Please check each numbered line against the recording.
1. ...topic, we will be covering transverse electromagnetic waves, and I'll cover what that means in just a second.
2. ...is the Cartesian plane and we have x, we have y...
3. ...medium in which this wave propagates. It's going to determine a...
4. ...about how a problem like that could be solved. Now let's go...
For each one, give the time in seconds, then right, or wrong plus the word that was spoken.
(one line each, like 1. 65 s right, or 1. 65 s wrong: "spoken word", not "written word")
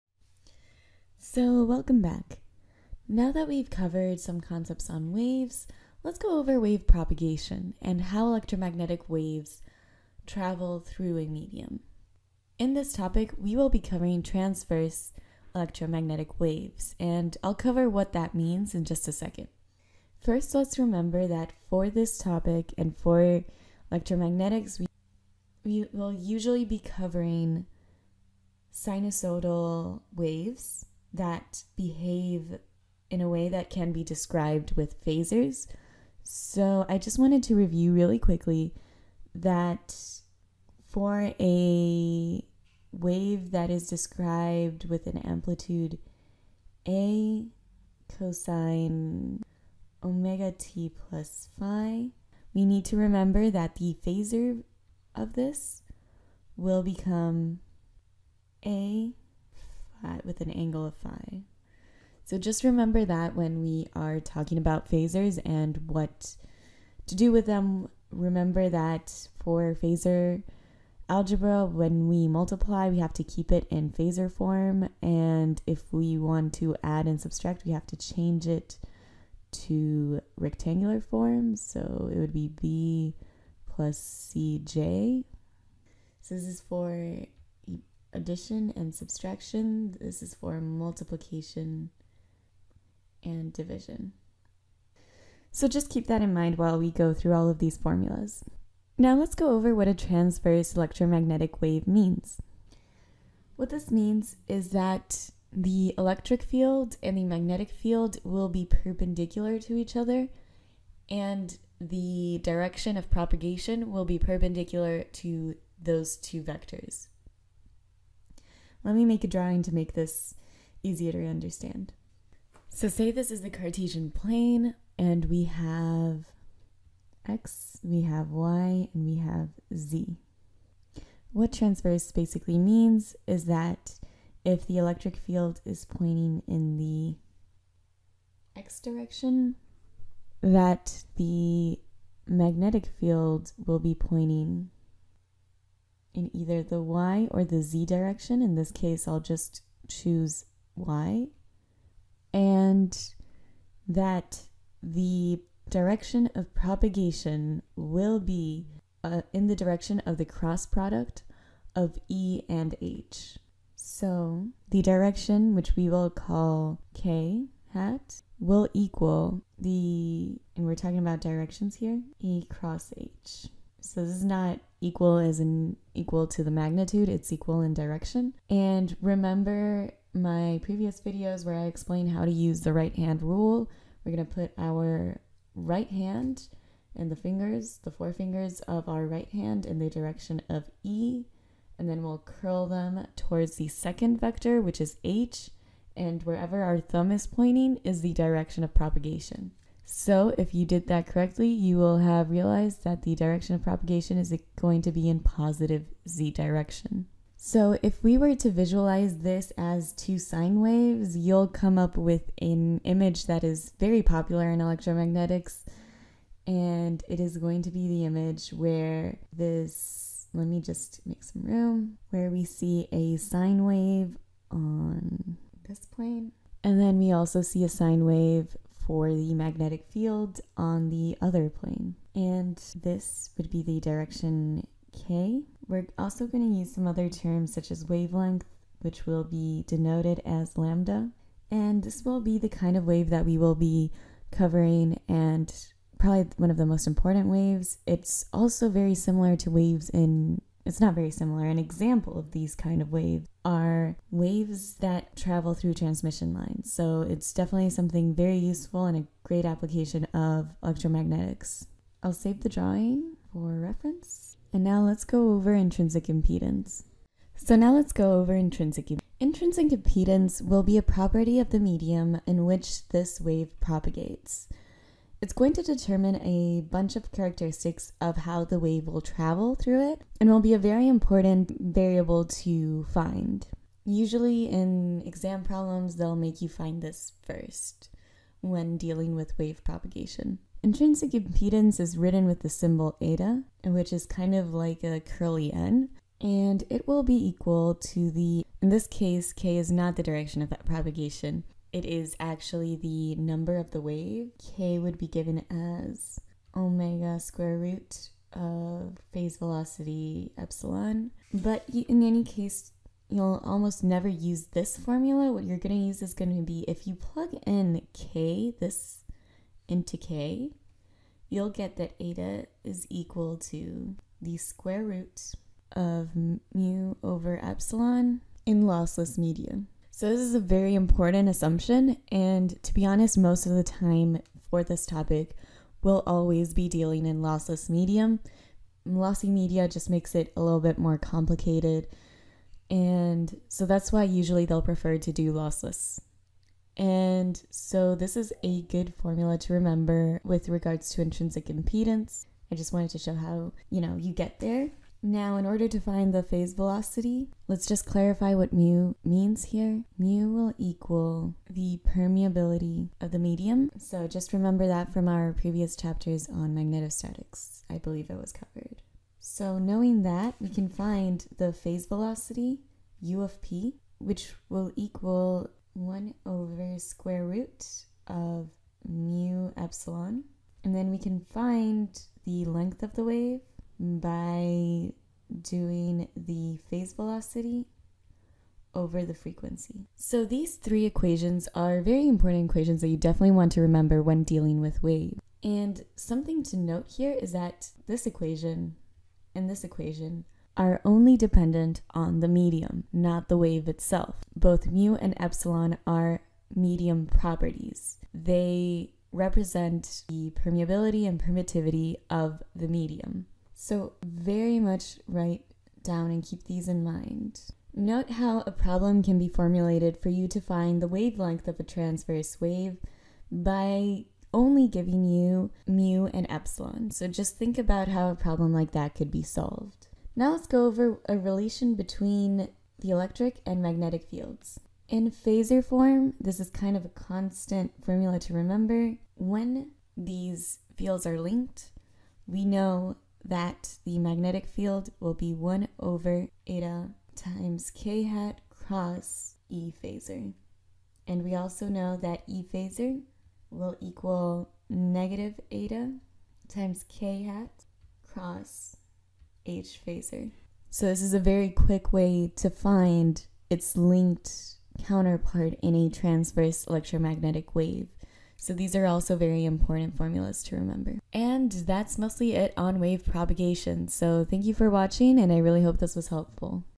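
1. 12 s right
2. 123 s right
3. 271 s right
4. 427 s right.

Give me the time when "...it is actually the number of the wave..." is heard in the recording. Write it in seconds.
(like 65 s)
301 s.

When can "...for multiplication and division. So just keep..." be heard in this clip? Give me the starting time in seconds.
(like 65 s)
90 s.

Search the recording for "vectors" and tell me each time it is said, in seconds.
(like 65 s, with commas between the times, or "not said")
116 s, 194 s.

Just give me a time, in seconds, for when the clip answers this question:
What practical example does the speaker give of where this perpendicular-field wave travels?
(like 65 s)
255 s.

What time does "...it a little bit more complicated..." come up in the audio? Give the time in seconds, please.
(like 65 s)
340 s.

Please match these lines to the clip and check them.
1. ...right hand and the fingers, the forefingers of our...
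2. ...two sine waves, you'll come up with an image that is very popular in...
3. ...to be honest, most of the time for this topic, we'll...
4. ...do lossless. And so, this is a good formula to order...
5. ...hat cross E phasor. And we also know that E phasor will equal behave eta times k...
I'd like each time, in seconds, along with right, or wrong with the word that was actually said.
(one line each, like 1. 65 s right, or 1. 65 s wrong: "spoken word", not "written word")
1. 185 s right
2. 209 s right
3. 332 s right
4. 345 s wrong: "remember", not "order"
5. 448 s wrong: "negative", not "behave".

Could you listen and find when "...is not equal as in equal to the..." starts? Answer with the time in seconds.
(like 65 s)
174 s.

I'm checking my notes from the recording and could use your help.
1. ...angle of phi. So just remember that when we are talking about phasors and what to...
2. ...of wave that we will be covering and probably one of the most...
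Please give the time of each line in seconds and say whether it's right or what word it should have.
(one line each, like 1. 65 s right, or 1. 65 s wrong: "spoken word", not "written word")
1. 60 s right
2. 242 s right.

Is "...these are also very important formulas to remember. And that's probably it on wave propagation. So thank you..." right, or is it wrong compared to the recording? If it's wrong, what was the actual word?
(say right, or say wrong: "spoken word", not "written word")
wrong: "mostly", not "probably".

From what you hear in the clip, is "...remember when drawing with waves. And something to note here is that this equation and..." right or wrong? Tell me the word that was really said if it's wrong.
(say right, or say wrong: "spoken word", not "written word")
wrong: "dealing", not "drawing".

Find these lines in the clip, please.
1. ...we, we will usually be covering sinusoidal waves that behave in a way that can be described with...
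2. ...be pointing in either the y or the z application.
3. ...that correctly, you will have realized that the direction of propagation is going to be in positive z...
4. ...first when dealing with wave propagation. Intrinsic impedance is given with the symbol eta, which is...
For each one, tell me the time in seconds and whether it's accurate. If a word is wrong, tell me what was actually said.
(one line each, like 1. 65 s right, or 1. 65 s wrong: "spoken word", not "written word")
1. 24 s right
2. 143 s wrong: "direction", not "application"
3. 200 s right
4. 287 s wrong: "written", not "given".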